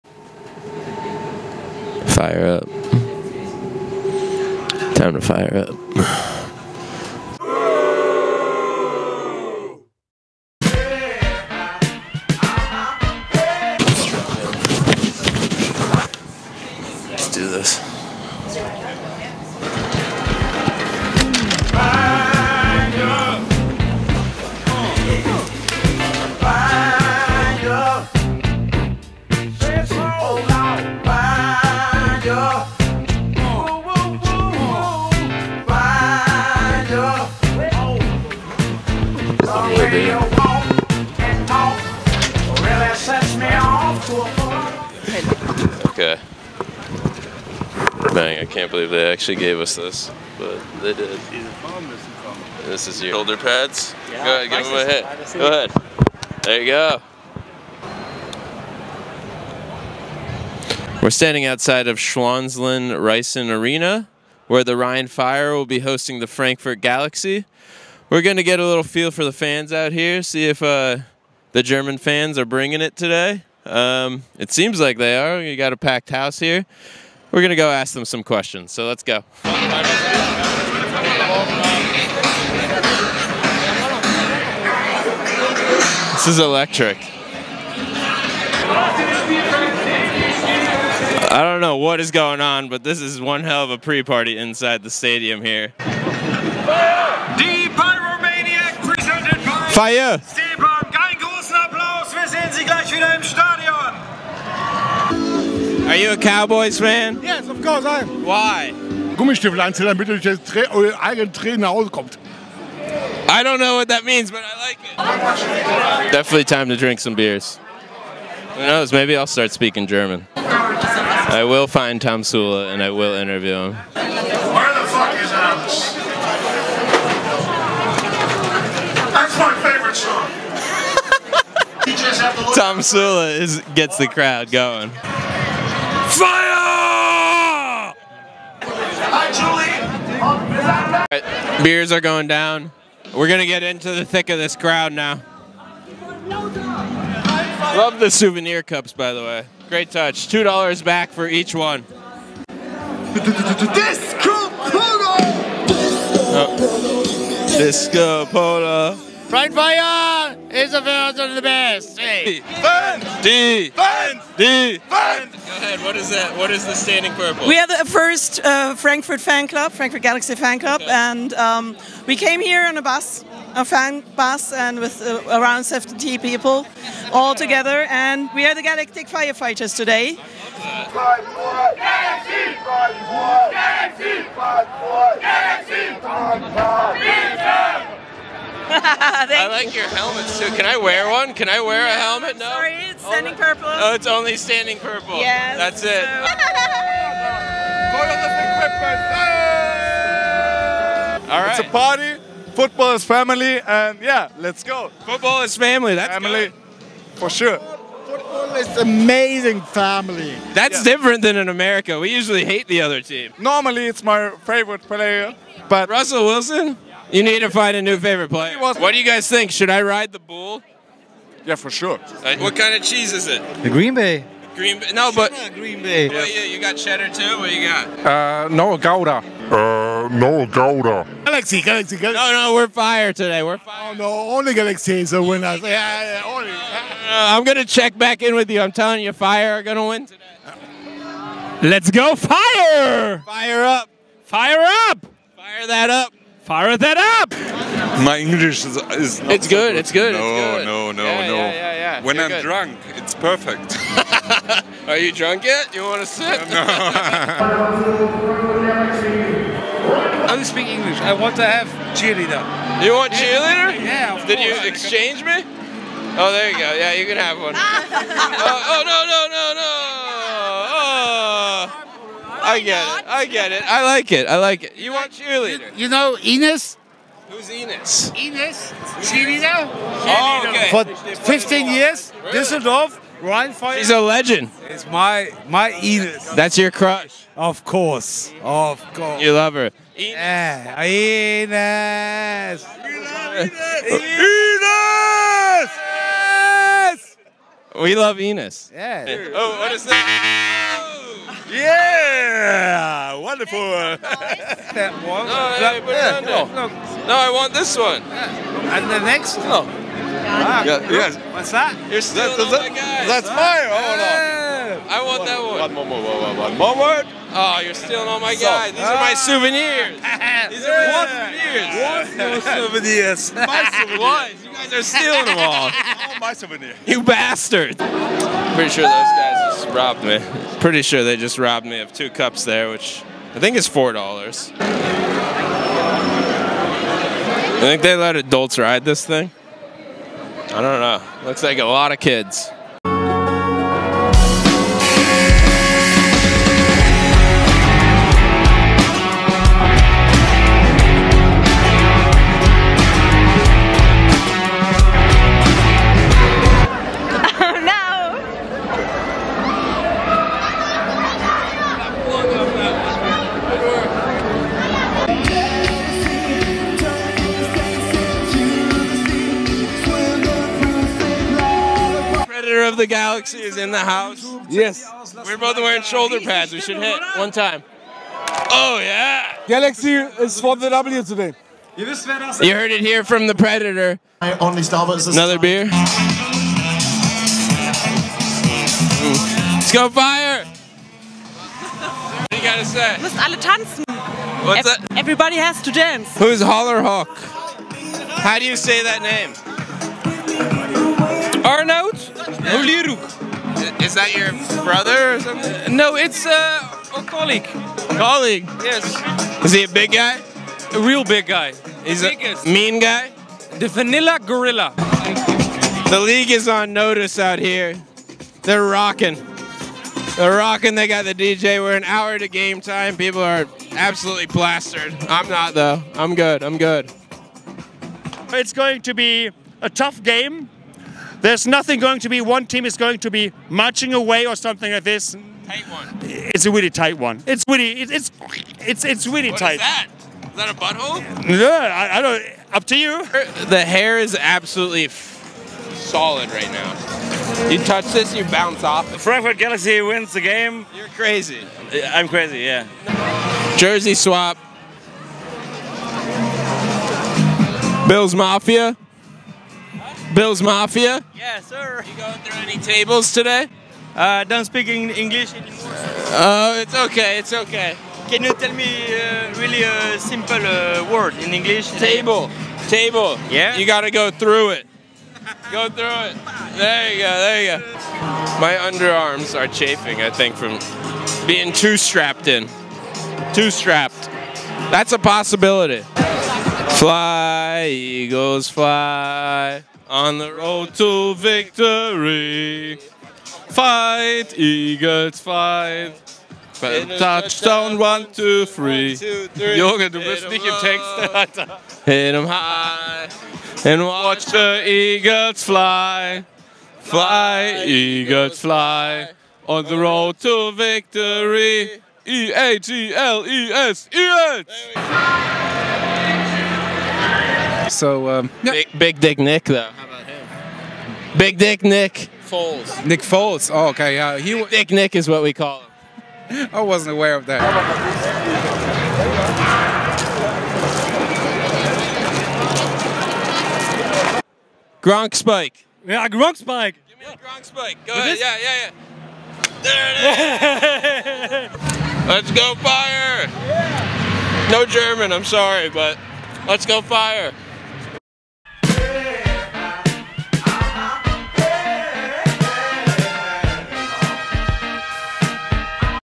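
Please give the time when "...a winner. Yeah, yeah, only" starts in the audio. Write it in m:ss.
3:55.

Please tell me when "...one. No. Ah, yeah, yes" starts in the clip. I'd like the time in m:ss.
5:09.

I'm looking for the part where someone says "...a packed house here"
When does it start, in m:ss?
1:15.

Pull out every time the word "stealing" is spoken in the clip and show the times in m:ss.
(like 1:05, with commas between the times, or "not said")
5:17, 5:24.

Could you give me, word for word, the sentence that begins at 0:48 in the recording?
Dang, I can't believe they actually gave us this, but they did.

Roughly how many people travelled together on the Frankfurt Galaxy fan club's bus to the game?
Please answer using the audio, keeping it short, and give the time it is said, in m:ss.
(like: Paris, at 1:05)
70, at 2:55.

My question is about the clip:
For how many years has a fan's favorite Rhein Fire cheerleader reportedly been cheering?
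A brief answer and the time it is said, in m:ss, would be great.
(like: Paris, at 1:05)
15 years, at 4:41.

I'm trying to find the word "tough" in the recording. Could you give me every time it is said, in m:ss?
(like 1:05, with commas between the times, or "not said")
7:09.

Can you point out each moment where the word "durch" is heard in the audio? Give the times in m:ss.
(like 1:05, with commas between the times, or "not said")
1:50.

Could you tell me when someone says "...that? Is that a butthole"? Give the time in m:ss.
7:19.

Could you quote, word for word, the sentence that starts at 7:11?
There's nothing going to be, one team is going to be marching away or something like this.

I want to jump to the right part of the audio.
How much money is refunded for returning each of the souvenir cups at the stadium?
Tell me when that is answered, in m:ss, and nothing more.
2:30.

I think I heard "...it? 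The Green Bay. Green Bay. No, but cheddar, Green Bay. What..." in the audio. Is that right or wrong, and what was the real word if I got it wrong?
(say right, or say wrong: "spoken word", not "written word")
right.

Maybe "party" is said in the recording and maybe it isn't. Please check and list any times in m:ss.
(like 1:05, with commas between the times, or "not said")
1:33, 3:21.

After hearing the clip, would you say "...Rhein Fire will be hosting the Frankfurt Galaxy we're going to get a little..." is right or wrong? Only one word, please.
right.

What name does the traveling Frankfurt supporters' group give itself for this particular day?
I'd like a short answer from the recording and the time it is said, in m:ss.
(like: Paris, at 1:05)
Galactic Firefighters, at 2:58.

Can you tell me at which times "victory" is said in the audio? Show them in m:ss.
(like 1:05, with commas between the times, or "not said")
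8:11, 8:30.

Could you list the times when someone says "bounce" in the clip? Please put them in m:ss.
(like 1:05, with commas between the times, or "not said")
7:28.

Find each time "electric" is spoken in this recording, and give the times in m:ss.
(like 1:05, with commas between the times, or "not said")
1:26.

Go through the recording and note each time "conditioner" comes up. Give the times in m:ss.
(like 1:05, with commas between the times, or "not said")
not said.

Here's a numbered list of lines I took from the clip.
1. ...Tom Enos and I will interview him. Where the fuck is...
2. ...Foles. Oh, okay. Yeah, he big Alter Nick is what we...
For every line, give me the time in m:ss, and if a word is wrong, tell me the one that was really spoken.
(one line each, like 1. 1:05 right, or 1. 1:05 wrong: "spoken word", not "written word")
1. 2:02 wrong: "Sula", not "Enos"
2. 8:43 wrong: "Dick", not "Alter".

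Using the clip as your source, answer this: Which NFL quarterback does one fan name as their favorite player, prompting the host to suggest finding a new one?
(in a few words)
Russell Wilson.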